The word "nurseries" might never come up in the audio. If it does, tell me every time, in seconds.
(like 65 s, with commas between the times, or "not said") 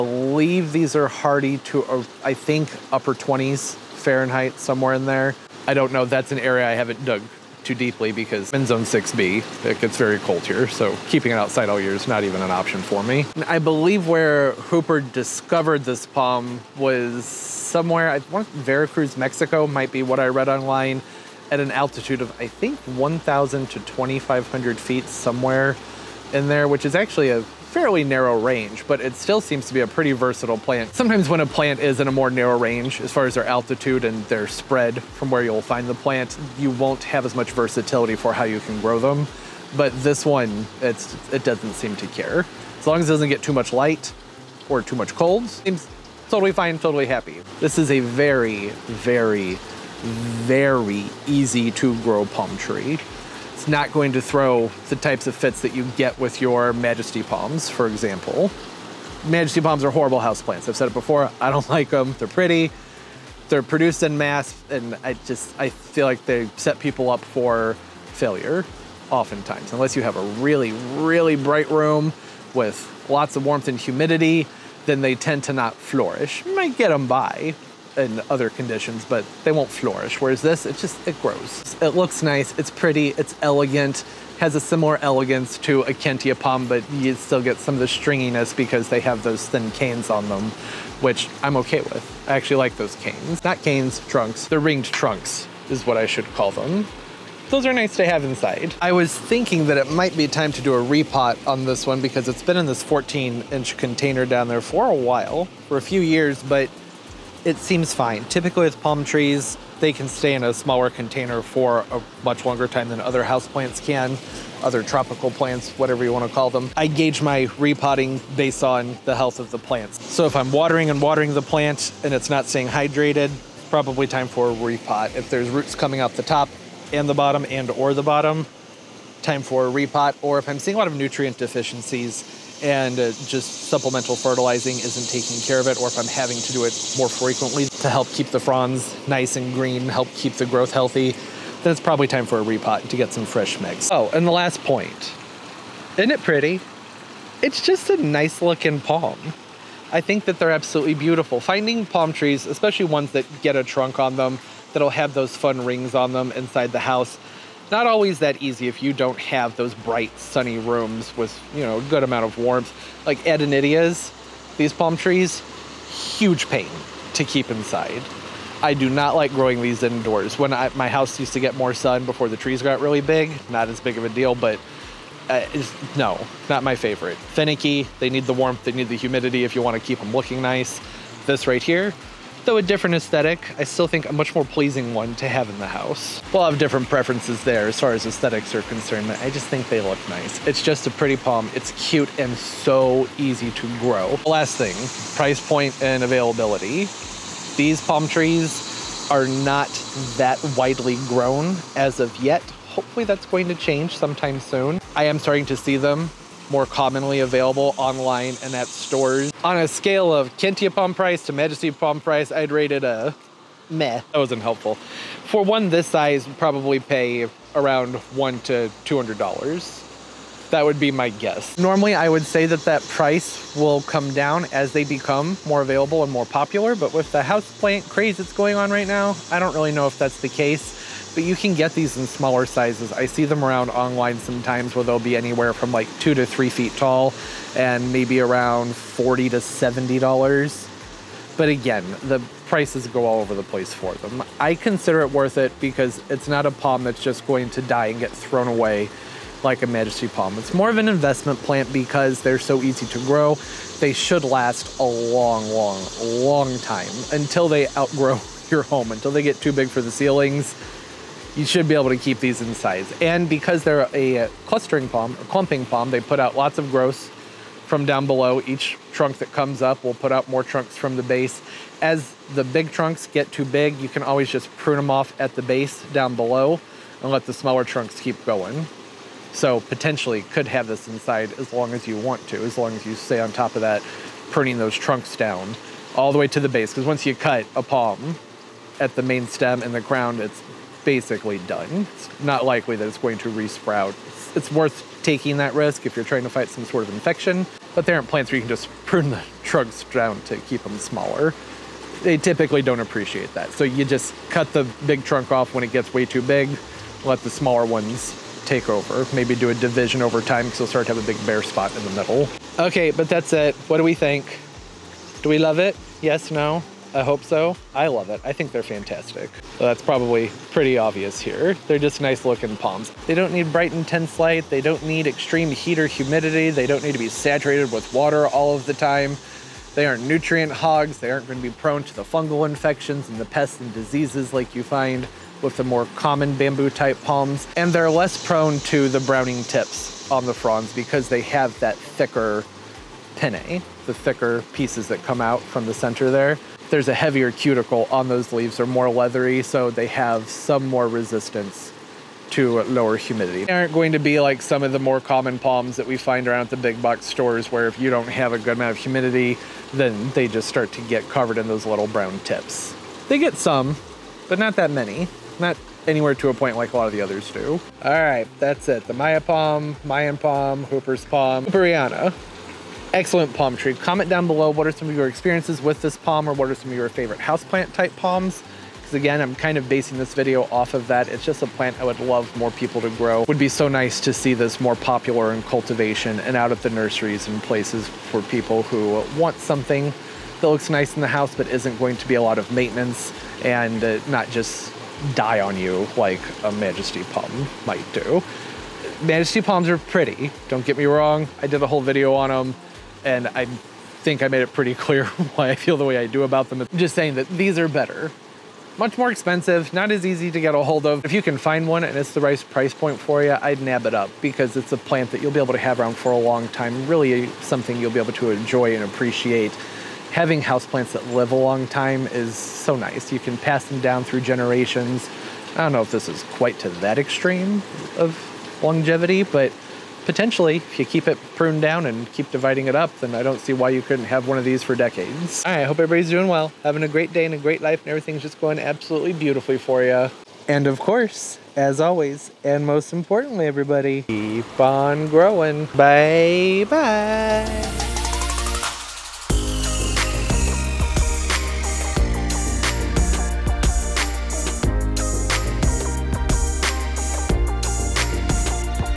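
386 s.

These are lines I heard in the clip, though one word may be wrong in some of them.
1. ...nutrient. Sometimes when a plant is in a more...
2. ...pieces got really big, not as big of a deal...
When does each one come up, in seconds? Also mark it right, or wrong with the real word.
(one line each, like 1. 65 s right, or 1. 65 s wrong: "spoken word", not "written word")
1. 30 s wrong: "plant", not "nutrient"
2. 172 s wrong: "trees", not "pieces".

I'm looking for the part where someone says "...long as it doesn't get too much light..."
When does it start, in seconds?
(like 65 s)
42 s.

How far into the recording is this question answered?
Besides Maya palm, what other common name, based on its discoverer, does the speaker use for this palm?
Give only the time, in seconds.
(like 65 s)
370 s.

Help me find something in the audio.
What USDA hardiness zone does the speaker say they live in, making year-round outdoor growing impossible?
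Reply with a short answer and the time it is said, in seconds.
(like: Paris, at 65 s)
6B, at 8 s.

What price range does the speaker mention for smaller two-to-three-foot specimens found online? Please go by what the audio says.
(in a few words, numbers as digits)
$40 to $70.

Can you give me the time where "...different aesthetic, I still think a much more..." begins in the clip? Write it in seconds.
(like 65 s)
182 s.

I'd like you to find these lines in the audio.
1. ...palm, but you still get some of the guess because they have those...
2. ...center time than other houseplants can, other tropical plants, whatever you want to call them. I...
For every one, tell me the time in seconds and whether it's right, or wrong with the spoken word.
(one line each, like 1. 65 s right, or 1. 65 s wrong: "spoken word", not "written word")
1. 86 s wrong: "stringiness", not "guess"
2. 112 s wrong: "longer", not "center".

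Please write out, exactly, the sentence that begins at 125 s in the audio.
If there's roots coming out the top and the bottom and or the bottom, time for a repot.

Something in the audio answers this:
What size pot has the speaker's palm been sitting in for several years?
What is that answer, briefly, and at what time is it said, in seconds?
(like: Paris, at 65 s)
14 inch, at 102 s.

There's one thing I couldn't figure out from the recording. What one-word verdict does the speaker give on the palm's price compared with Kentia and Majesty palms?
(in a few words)
meh.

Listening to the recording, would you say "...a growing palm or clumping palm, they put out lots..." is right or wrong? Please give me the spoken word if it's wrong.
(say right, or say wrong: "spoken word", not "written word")
wrong: "clustering", not "growing".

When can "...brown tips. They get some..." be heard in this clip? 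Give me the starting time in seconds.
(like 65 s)
361 s.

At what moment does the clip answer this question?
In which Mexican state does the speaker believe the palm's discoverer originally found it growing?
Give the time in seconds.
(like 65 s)
18 s.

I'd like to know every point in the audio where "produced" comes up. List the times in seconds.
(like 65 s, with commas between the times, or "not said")
63 s.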